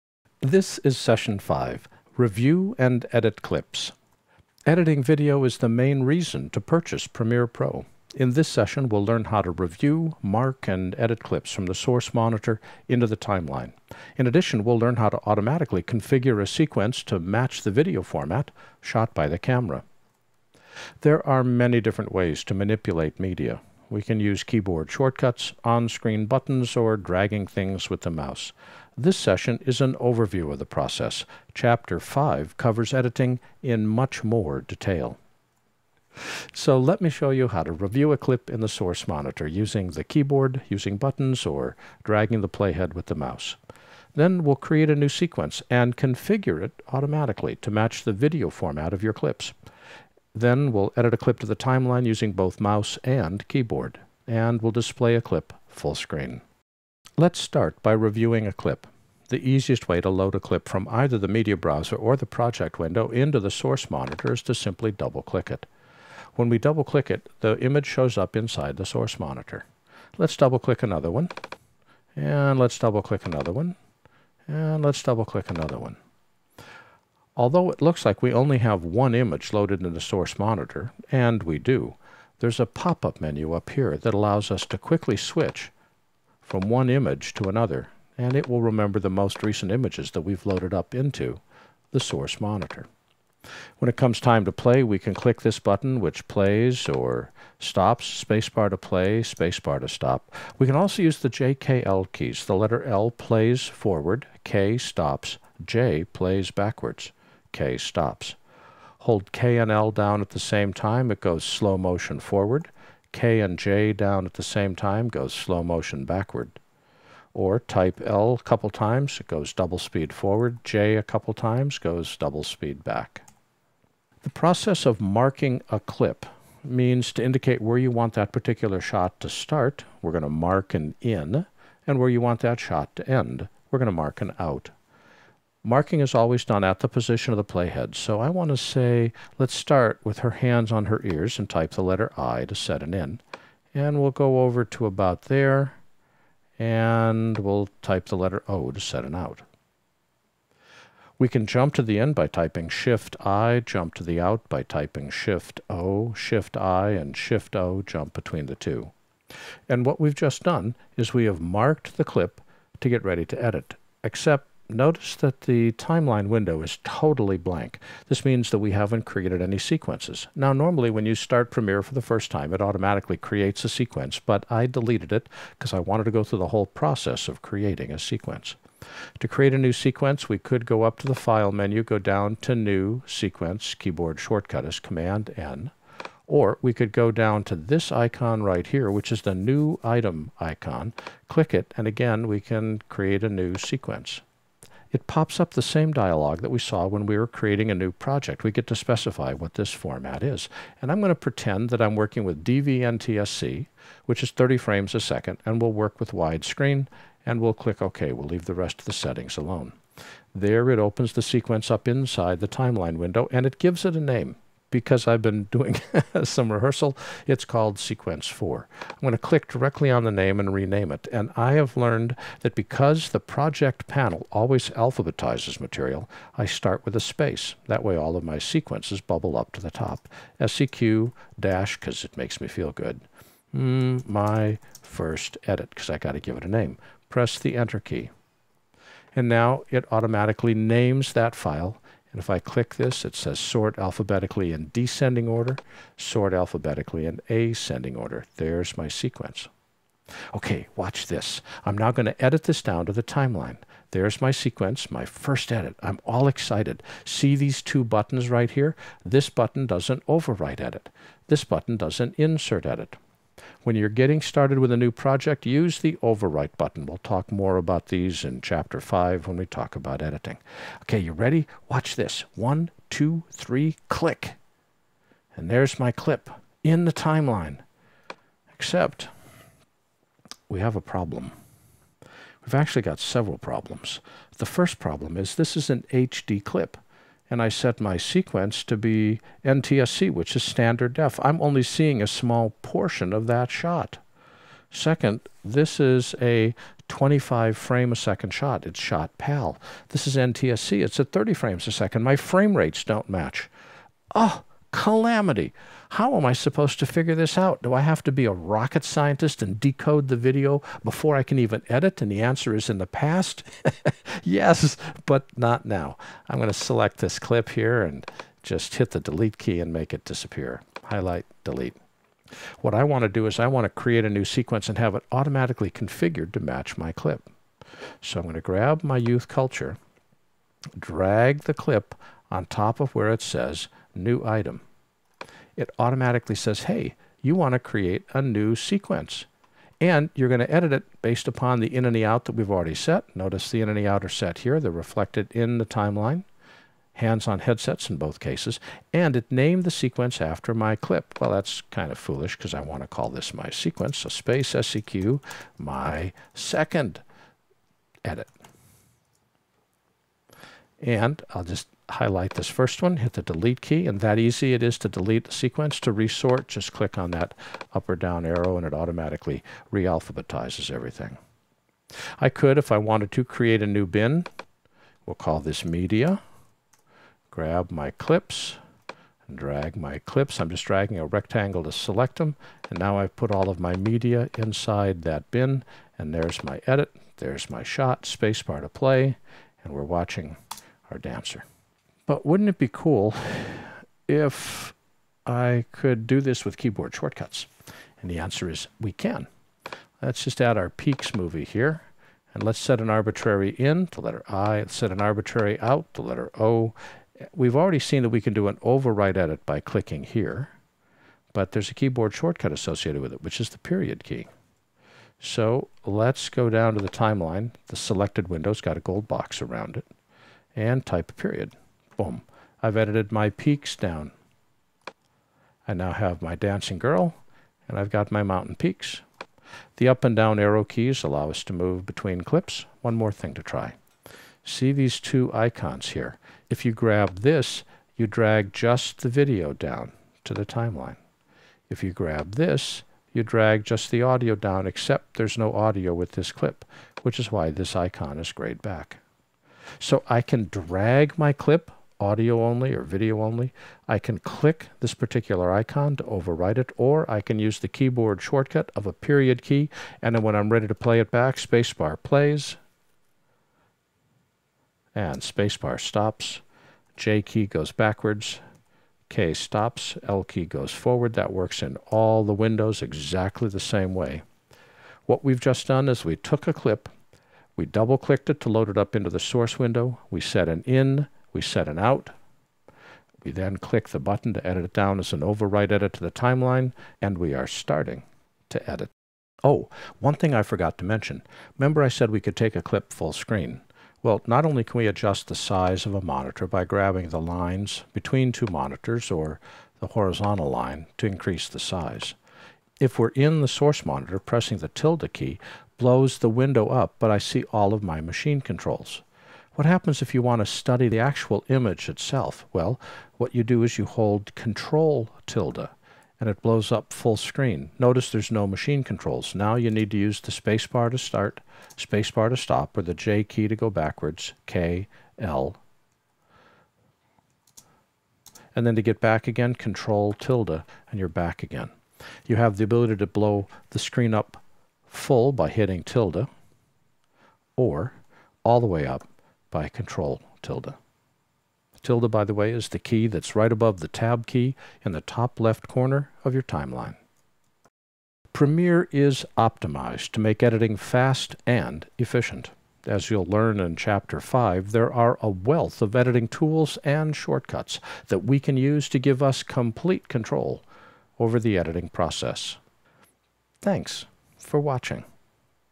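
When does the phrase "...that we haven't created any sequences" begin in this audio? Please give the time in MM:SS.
02:48.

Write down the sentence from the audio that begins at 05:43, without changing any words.
Notice the in and the out are set here.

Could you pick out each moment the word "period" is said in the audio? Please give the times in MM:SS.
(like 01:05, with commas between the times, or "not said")
06:53, 07:01, 07:38.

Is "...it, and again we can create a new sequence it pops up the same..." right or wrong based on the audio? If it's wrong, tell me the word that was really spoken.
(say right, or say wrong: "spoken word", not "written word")
right.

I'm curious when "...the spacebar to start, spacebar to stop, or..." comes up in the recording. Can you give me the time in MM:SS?
08:40.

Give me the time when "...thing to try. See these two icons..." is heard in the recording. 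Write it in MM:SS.
07:13.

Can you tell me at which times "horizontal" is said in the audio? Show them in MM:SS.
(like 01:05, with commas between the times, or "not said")
08:19.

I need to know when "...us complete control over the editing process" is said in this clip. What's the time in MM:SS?
09:19.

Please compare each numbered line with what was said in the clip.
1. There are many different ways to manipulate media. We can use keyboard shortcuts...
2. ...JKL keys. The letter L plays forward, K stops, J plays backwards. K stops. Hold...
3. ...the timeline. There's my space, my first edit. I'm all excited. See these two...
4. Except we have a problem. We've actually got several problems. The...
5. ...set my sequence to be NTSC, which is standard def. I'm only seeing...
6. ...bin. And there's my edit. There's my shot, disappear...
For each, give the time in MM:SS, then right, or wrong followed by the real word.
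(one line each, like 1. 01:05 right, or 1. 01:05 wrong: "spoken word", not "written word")
1. 00:21 right
2. 01:41 right
3. 04:12 wrong: "sequence", not "space"
4. 04:38 right
5. 04:47 right
6. 06:25 wrong: "spacebar", not "disappear".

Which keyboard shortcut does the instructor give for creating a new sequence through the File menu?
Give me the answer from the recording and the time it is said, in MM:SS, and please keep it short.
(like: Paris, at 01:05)
Command-N, at 03:04.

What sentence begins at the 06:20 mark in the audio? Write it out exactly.
I'm just dragging a rectangle to select them.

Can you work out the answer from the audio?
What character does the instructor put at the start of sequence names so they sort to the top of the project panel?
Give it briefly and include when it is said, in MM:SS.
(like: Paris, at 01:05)
a space, at 03:46.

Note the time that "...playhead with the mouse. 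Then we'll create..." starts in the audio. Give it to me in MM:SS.
00:42.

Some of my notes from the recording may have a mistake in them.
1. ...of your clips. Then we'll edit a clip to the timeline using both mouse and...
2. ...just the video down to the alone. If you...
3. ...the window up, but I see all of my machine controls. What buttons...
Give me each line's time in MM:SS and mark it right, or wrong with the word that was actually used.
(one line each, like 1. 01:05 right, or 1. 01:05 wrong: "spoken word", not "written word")
1. 00:48 right
2. 07:18 wrong: "timeline", not "alone"
3. 08:26 wrong: "happens", not "buttons".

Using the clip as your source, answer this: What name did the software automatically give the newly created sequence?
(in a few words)
Sequence 4.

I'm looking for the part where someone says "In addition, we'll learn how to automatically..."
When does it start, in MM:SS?
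00:14.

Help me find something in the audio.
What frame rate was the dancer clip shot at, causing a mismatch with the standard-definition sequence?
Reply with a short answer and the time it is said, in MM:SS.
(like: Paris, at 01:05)
25 frames a second, at 04:56.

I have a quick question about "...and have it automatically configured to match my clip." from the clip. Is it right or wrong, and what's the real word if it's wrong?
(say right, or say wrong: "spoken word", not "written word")
right.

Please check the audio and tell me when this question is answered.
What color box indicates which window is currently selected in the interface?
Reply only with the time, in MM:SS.
06:58.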